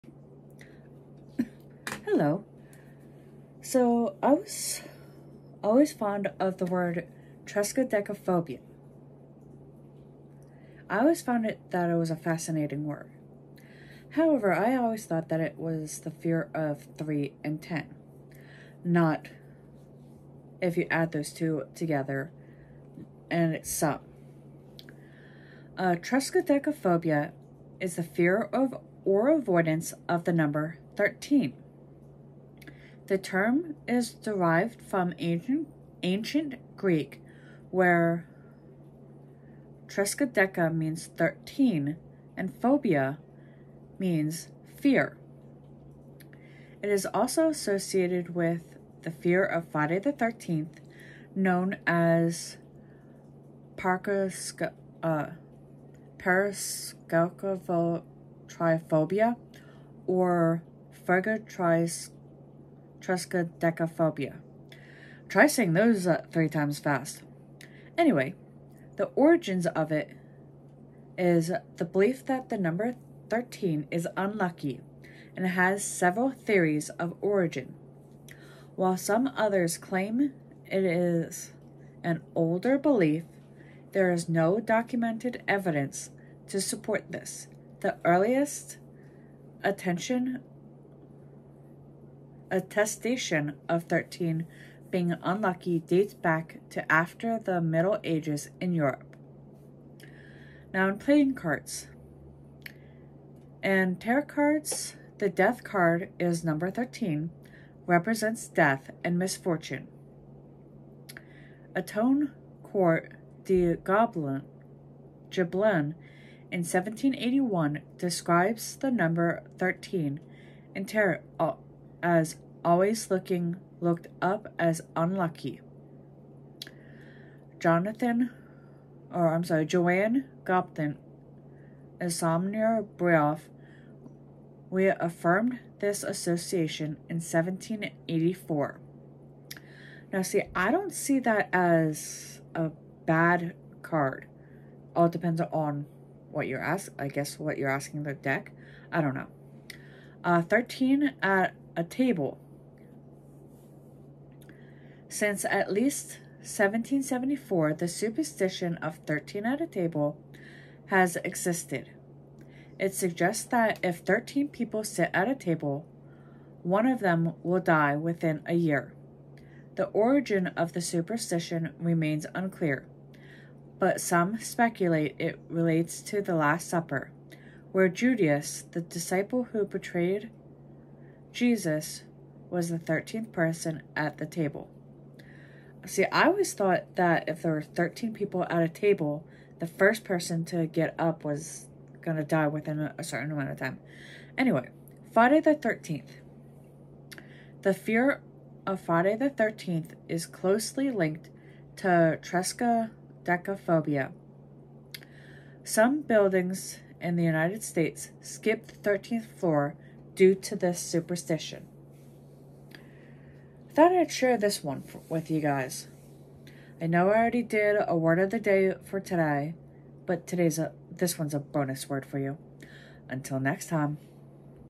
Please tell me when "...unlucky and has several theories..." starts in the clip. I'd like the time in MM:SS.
01:14.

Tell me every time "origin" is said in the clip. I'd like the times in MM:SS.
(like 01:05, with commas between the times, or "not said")
01:09, 01:17, 02:49.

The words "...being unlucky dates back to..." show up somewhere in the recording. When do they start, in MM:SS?
01:34.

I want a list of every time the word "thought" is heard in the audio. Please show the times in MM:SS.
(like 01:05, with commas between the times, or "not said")
00:15, 03:06, 03:33.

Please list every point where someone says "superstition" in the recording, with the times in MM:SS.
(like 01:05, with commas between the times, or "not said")
02:37, 02:50, 03:30.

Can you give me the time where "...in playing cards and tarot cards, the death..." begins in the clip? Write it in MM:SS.
01:40.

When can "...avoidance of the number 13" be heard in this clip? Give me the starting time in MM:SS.
00:29.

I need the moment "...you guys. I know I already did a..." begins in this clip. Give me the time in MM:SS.
03:35.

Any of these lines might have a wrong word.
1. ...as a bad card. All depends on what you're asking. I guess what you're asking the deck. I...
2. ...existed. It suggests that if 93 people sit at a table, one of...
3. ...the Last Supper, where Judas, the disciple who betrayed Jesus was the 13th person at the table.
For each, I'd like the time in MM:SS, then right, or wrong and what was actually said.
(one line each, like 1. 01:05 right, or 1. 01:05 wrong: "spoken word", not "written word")
1. 02:21 right
2. 02:41 wrong: "13", not "93"
3. 02:56 right.